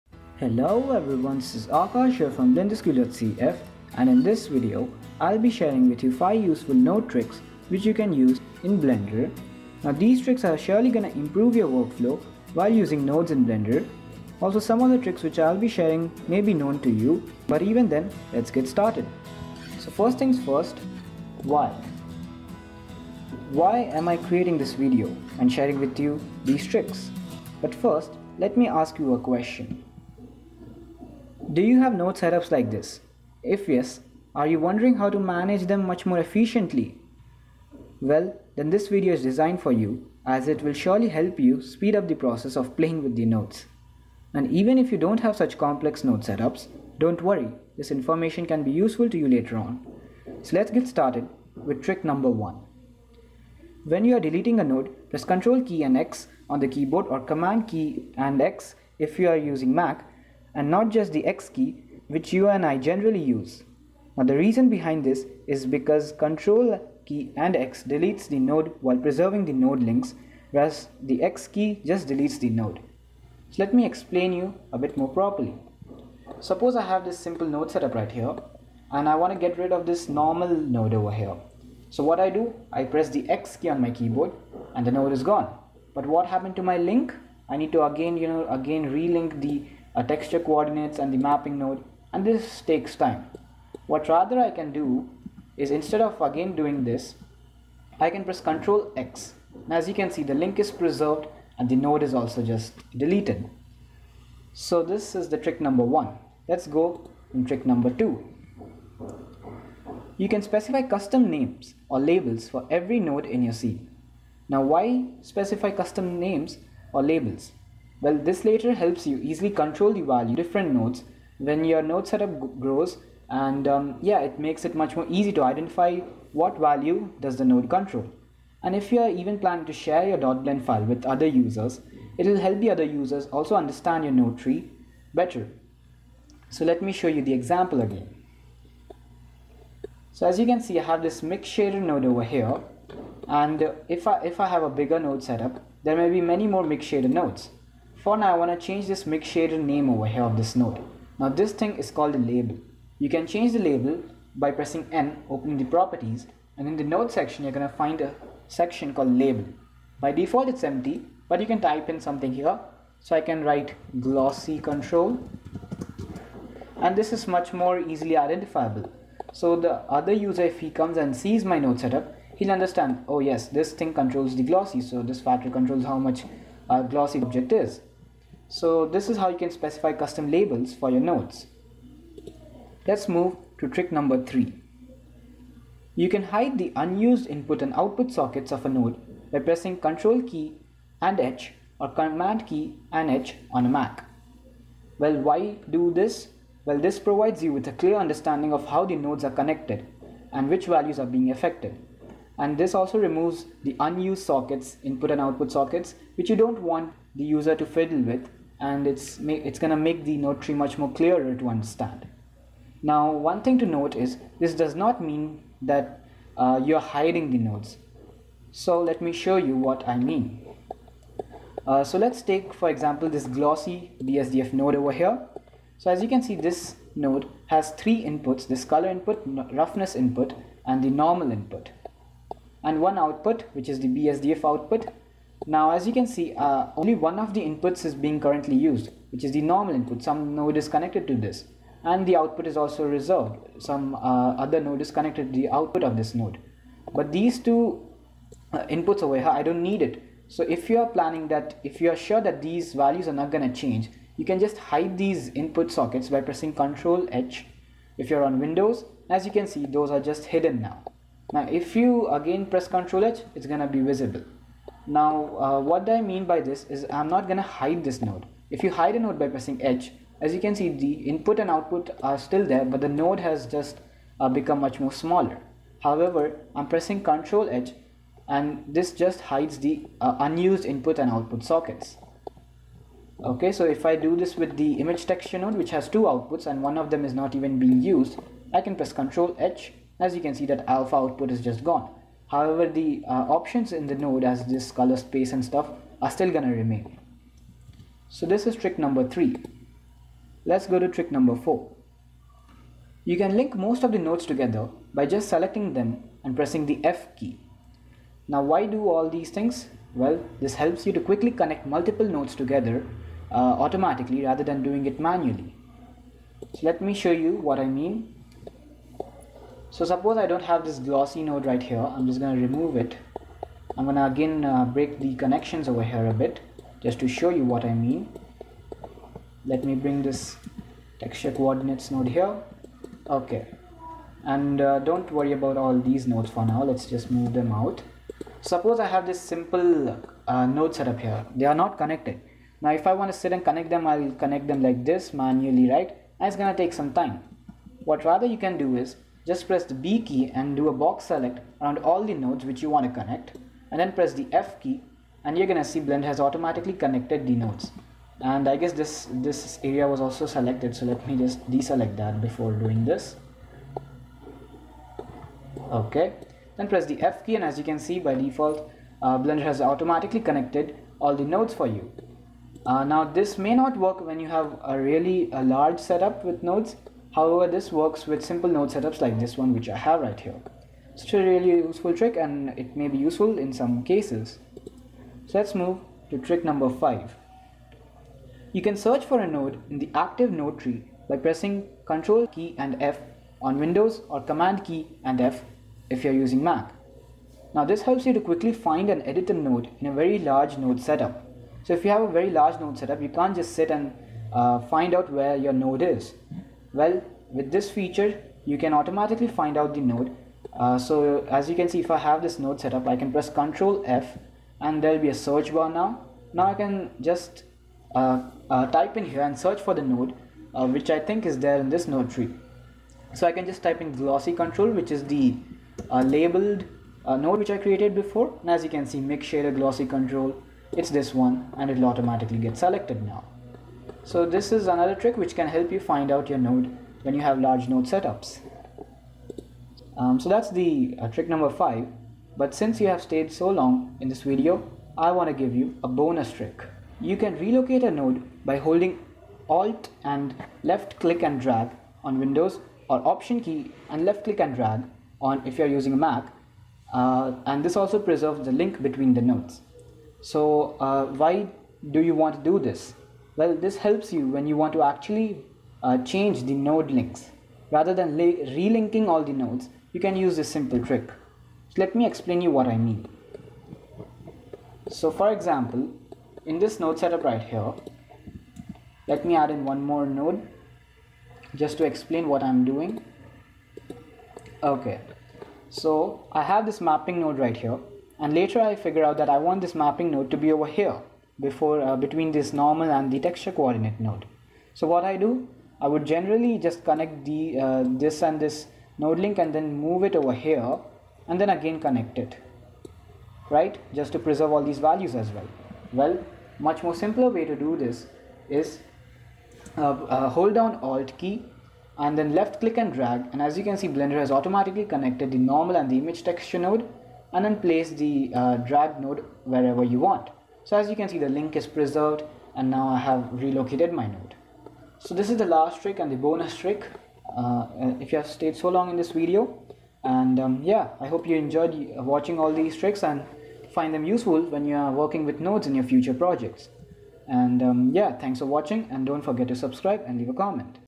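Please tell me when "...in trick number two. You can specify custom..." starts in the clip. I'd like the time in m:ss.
1:47.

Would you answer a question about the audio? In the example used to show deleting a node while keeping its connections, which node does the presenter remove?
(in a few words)
Normal node.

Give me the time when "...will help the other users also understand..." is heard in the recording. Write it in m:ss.
2:12.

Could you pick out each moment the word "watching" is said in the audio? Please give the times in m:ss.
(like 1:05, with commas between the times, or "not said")
8:51, 8:58.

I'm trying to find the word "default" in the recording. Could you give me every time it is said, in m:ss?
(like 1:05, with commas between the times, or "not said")
2:40, 6:08.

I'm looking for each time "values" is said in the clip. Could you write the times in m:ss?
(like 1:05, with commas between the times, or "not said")
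2:00, 2:06, 3:20, 4:12, 8:24.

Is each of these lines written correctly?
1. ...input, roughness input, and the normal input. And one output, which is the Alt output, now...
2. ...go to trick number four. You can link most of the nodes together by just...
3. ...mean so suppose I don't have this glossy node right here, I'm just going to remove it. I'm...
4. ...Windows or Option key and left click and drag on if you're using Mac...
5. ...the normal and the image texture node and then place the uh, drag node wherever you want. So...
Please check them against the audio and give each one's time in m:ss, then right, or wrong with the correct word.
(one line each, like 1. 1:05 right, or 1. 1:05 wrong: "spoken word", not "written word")
1. 3:48 wrong: "BSDF", not "Alt"
2. 5:00 right
3. 5:17 right
4. 7:32 right
5. 8:35 right.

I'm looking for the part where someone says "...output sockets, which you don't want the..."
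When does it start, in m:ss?
3:25.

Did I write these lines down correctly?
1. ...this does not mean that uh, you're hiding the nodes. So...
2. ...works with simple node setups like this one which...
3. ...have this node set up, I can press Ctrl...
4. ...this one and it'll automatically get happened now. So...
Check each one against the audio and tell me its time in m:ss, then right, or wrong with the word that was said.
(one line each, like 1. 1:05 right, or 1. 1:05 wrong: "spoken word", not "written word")
1. 3:34 right
2. 6:17 right
3. 6:51 wrong: "Control", not "Ctrl"
4. 7:10 wrong: "selected", not "happened".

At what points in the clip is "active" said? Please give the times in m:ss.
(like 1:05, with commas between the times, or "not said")
6:29.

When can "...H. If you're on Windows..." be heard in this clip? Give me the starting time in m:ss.
4:17.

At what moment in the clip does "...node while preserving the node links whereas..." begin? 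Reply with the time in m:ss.
1:08.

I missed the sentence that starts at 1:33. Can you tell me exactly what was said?
What rather I can do is instead of again doing this, I can press Ctrl X.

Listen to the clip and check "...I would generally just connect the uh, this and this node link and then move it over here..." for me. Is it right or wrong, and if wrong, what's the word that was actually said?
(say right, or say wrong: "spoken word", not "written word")
right.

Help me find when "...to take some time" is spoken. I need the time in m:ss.
5:46.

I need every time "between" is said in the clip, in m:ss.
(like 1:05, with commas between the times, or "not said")
7:38, 8:11.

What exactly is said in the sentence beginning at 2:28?
For now, I want to change this mix shader name over here of this node.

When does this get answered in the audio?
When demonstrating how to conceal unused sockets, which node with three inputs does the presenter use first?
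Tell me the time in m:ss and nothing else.
3:43.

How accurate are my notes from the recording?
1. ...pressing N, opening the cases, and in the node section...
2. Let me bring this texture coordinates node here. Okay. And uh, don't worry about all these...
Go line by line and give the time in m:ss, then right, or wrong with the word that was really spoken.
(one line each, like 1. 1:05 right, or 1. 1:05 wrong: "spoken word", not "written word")
1. 2:34 wrong: "properties", not "cases"
2. 5:29 right.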